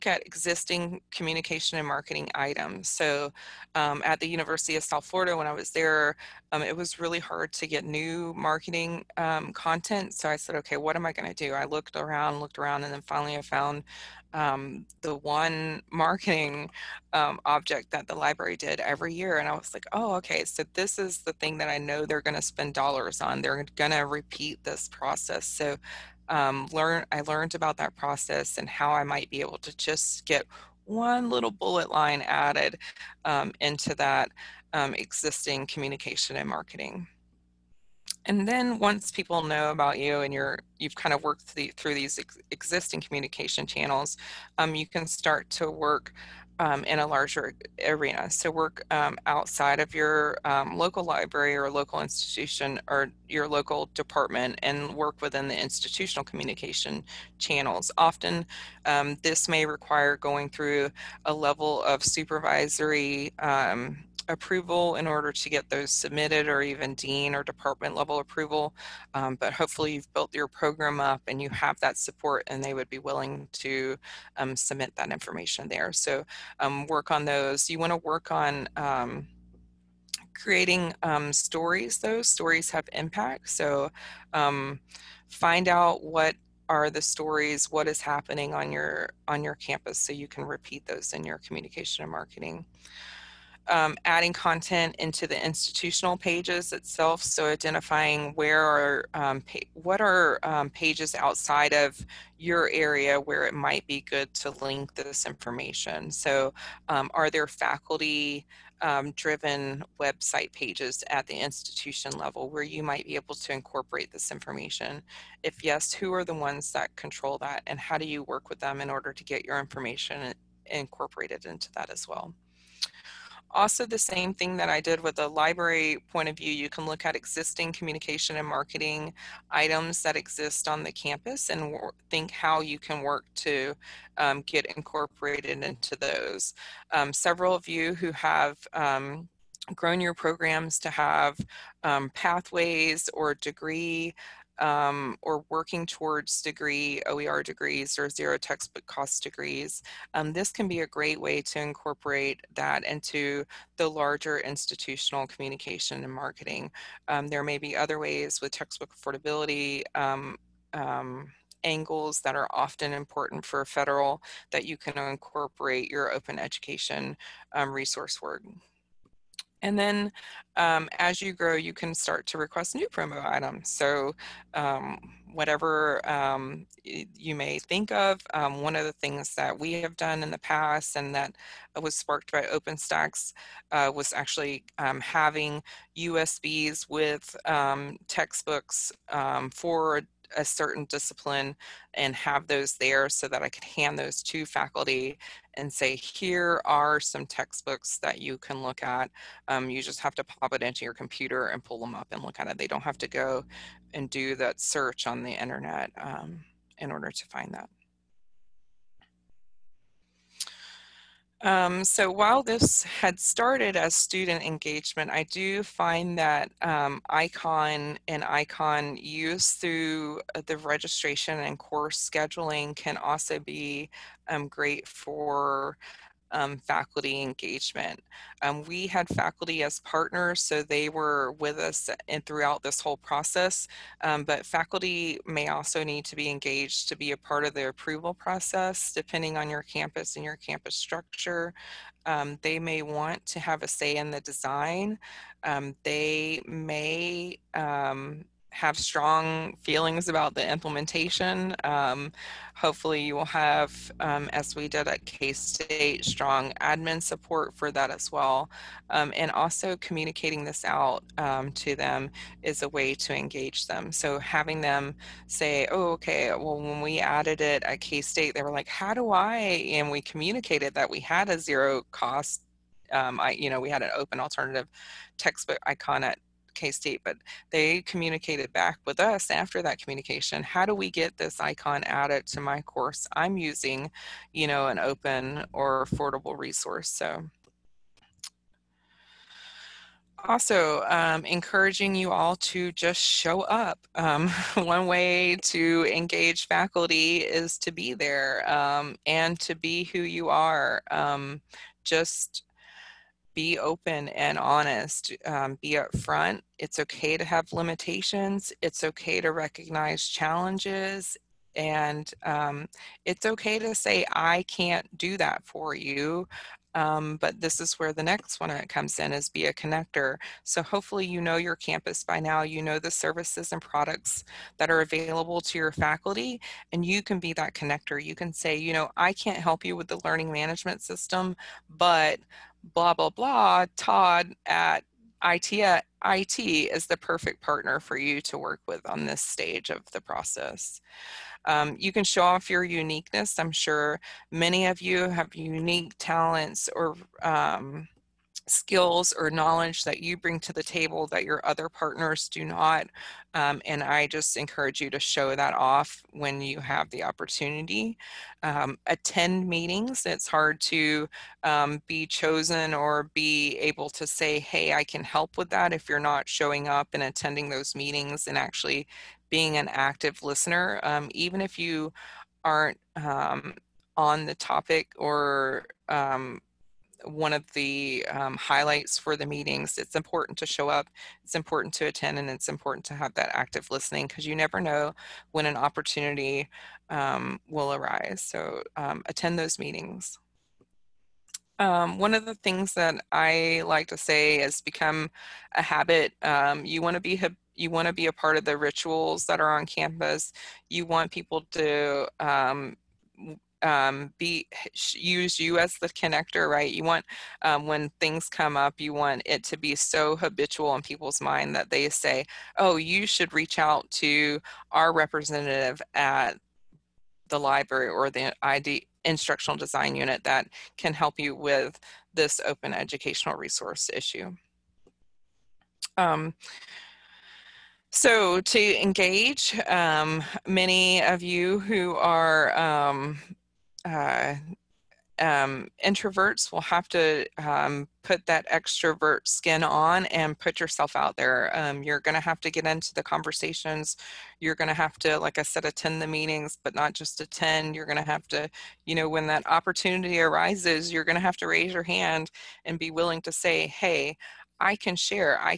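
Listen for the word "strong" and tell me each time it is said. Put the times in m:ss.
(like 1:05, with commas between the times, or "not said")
4:08, 4:16.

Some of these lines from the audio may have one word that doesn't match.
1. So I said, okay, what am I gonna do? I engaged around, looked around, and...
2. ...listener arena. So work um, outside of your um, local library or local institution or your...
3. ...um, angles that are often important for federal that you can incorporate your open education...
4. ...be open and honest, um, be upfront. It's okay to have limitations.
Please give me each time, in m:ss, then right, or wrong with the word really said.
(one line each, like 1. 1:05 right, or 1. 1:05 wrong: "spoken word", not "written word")
1. 0:10 wrong: "looked", not "engaged"
2. 0:47 wrong: "larger", not "listener"
3. 2:40 right
4. 5:03 right.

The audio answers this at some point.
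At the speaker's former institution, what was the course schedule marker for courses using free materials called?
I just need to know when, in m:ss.
4:33.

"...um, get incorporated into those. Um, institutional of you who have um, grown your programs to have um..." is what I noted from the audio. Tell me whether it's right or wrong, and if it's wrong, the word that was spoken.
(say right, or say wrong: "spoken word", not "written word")
wrong: "several", not "institutional".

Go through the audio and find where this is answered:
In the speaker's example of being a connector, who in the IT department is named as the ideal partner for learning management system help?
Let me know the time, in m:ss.
5:33.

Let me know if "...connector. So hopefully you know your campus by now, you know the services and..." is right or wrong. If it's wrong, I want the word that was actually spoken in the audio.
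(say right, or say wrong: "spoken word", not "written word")
right.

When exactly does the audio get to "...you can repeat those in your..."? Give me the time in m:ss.
1:30.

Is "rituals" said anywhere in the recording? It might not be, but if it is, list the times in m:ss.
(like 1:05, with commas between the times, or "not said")
6:38.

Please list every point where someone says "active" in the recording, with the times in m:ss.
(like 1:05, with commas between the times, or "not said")
6:09, 6:23.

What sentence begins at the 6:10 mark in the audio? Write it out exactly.
Um, even if you aren't um, on the topic or um, one of the um, highlights for the meetings.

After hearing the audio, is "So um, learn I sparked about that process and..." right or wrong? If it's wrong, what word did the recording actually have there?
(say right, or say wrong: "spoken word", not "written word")
wrong: "learned", not "sparked".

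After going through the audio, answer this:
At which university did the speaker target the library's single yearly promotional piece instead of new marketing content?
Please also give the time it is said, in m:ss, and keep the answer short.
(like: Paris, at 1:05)
University of South Florida, at 0:04.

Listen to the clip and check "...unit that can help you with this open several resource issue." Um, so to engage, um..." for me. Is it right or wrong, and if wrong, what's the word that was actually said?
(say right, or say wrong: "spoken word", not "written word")
wrong: "educational", not "several".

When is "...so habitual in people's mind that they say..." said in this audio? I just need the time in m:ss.
6:49.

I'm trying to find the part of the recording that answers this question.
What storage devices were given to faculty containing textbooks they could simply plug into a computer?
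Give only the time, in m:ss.
3:05.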